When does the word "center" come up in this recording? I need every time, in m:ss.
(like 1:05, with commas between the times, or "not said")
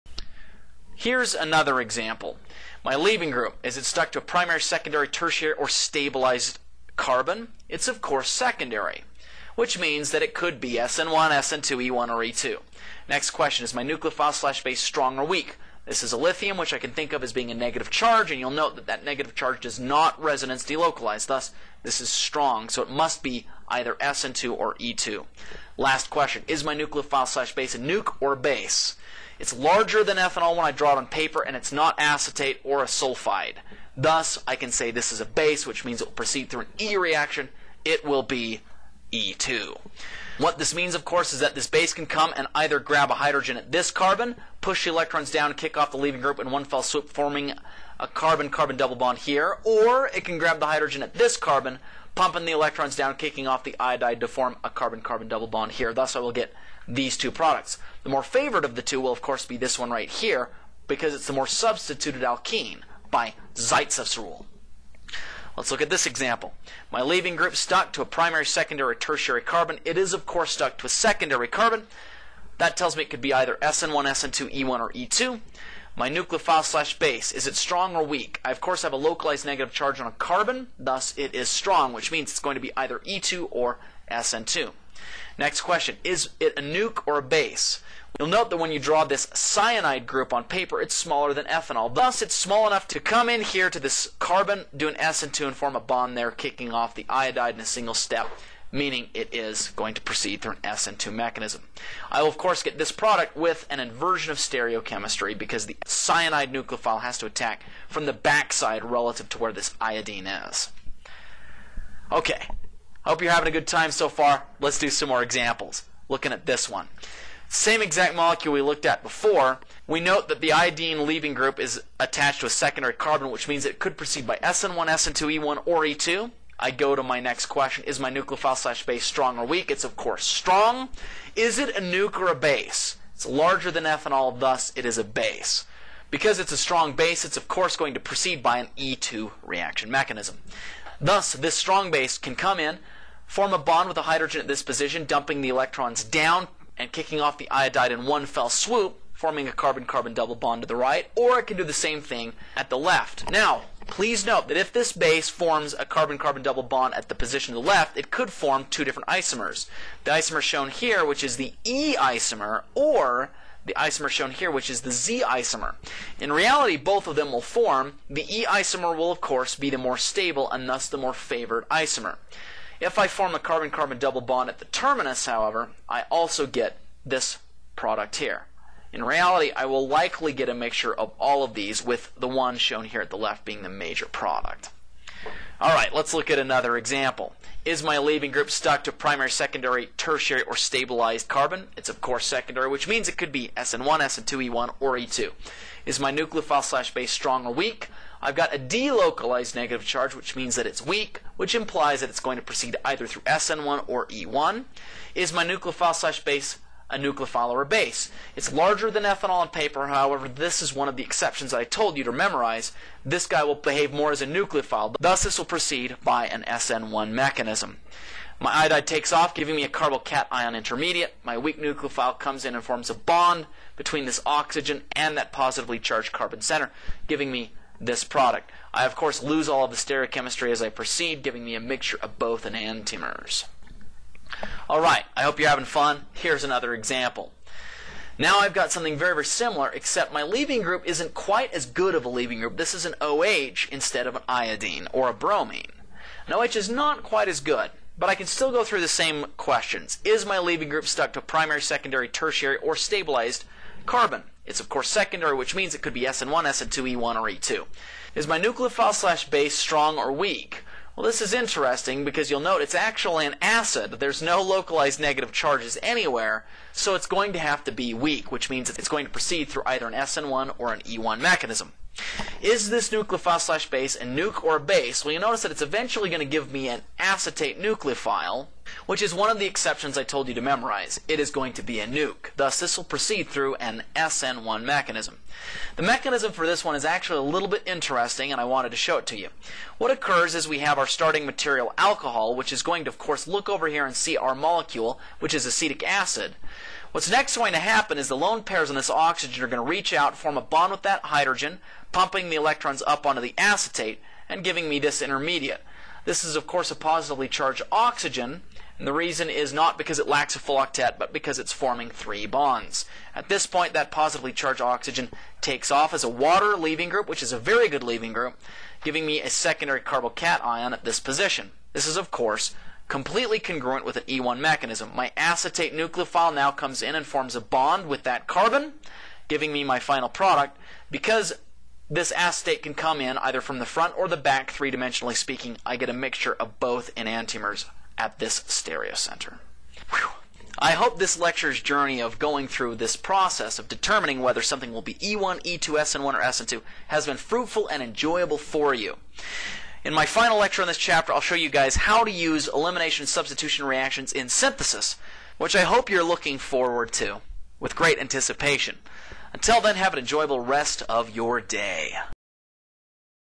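3:46, 5:38.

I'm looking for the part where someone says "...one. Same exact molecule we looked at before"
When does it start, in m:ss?
1:56.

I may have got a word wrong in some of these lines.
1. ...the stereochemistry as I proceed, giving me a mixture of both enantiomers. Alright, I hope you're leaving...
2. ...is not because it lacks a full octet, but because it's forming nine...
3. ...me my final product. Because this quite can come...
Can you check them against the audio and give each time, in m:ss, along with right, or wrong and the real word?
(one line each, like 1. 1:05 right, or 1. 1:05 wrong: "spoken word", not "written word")
1. 3:49 wrong: "having", not "leaving"
2. 5:09 wrong: "three", not "nine"
3. 5:29 wrong: "acetate", not "quite".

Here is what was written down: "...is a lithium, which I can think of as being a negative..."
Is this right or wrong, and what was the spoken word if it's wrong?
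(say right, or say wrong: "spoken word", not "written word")
right.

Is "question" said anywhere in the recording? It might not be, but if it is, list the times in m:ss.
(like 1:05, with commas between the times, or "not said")
0:13, 0:26, 1:25, 2:07, 4:09.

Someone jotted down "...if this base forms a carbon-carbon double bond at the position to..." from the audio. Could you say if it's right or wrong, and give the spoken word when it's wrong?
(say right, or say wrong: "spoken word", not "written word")
right.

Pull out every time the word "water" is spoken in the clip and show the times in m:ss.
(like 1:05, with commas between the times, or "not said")
5:16.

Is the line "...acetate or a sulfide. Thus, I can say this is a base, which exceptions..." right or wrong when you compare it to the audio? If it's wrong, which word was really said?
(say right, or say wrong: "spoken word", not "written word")
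wrong: "means", not "exceptions".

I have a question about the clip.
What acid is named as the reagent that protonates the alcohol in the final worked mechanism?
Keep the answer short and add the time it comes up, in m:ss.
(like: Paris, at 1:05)
acetic acid, at 4:55.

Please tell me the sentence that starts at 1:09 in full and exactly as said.
It is of course stuck to a secondary carbon.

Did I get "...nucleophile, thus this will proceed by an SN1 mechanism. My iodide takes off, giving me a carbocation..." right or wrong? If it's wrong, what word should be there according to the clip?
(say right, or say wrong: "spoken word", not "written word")
right.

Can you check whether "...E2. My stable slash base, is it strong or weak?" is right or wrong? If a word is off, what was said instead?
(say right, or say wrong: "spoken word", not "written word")
wrong: "nucleophile", not "stable".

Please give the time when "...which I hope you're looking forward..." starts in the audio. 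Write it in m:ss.
5:55.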